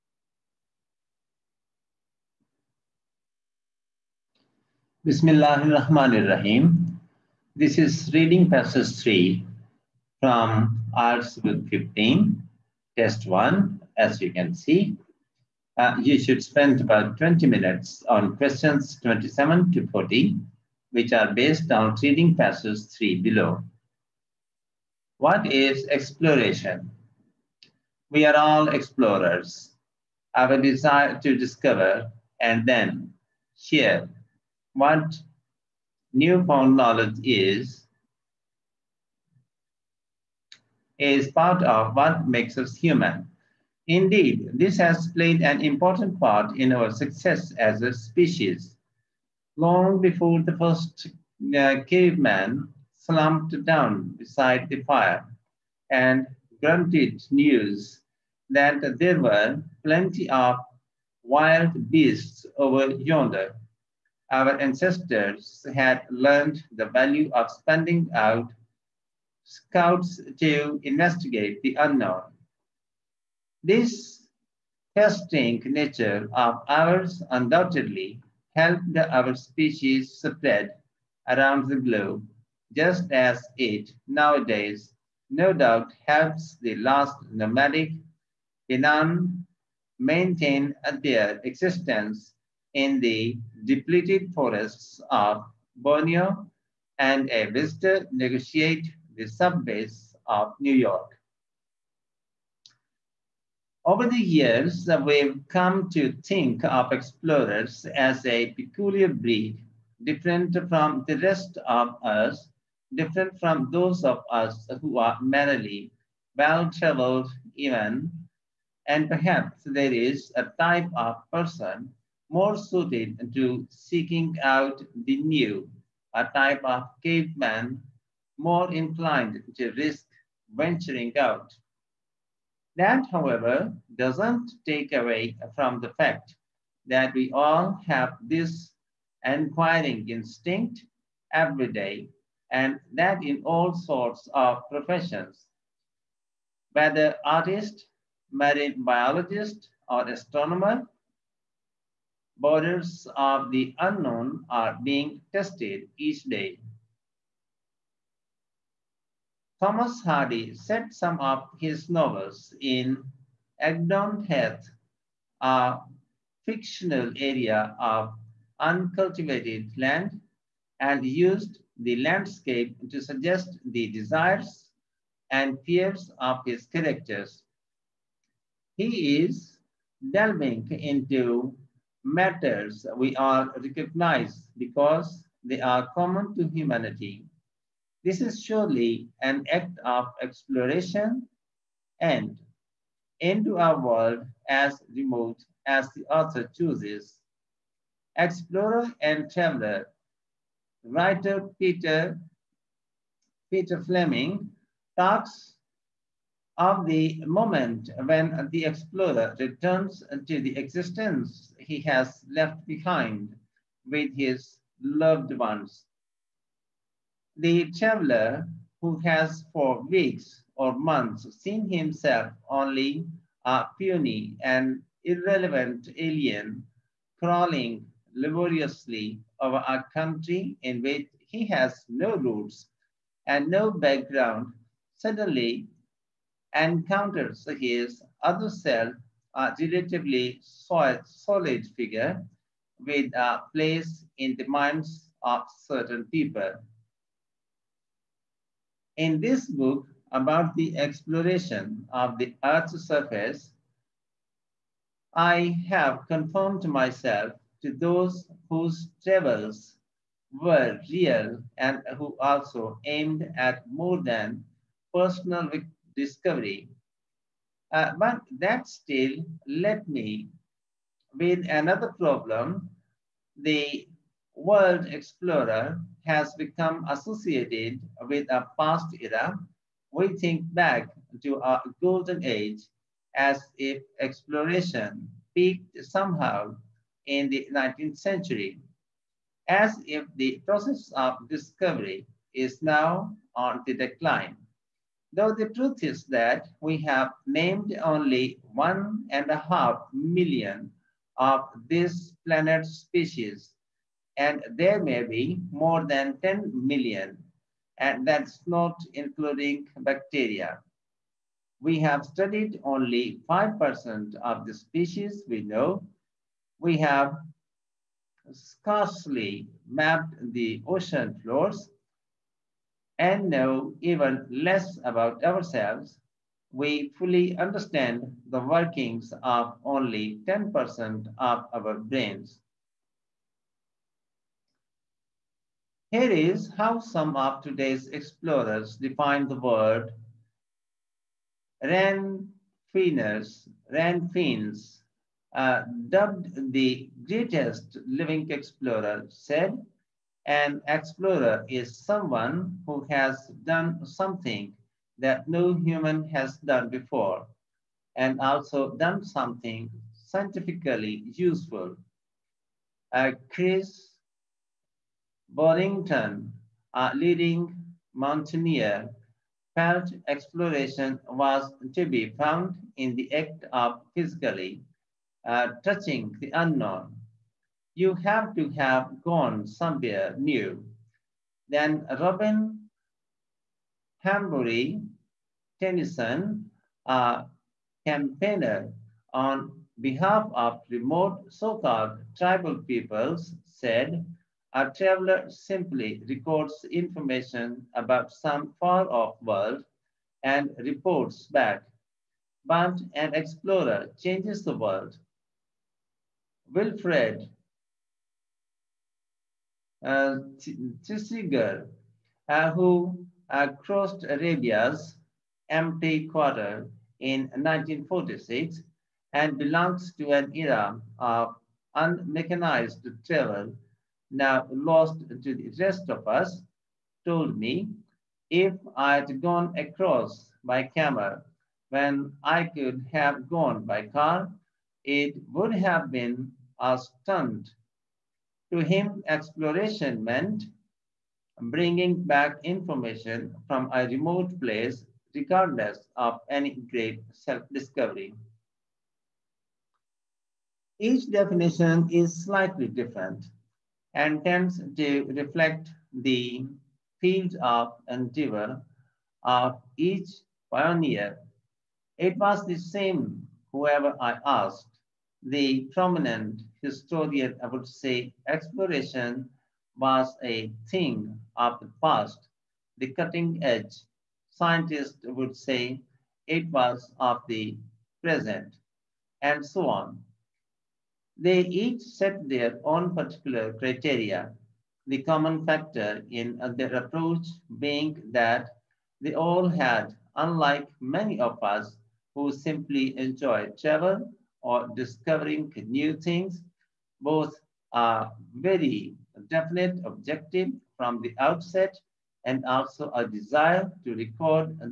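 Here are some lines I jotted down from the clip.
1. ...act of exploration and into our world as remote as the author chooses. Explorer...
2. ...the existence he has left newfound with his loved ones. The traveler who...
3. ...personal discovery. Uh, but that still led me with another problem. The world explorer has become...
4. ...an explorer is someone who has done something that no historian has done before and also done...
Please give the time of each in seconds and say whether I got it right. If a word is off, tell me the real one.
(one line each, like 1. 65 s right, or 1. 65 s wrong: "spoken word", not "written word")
1. 189 s right
2. 210 s wrong: "behind", not "newfound"
3. 264 s right
4. 350 s wrong: "human", not "historian".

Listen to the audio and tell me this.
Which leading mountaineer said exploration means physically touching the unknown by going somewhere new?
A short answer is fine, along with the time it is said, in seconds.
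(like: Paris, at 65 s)
Chris Bonington, at 363 s.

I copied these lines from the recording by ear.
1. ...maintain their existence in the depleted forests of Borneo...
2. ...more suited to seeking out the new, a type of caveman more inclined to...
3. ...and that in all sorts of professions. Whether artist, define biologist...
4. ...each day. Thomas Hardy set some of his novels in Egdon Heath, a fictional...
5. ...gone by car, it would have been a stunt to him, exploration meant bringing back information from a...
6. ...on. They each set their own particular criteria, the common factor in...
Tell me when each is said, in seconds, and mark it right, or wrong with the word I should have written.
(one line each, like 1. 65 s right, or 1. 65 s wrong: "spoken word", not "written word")
1. 89 s right
2. 122 s right
3. 142 s wrong: "marine", not "define"
4. 155 s right
5. 433 s right
6. 479 s right.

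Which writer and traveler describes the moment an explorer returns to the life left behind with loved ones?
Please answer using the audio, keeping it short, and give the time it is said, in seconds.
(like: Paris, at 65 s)
Peter Fleming, at 203 s.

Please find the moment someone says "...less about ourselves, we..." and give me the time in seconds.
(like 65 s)
324 s.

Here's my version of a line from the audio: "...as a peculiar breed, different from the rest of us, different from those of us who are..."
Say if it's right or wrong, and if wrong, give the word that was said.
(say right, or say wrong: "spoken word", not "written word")
right.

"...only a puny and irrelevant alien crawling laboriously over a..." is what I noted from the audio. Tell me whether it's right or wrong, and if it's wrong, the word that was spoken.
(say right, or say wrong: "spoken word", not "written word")
right.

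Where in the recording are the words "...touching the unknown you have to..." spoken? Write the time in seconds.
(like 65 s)
375 s.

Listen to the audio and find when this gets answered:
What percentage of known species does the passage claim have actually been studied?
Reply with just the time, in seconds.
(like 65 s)
313 s.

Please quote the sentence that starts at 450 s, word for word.
Each definition is slightly different and tends to reflect the field of endeavor of each pioneer.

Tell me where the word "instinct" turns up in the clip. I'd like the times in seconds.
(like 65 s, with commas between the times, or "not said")
140 s.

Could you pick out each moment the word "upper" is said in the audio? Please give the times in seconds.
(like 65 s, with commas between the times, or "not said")
not said.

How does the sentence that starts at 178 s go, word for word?
He is delving into matters we are recognized because they are common to humanity.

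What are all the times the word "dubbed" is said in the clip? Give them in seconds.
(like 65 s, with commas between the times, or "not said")
345 s.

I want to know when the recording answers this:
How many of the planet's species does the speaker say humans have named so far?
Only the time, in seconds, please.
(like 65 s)
298 s.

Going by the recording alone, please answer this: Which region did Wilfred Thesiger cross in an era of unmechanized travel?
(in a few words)
Arabia's Empty Quarter.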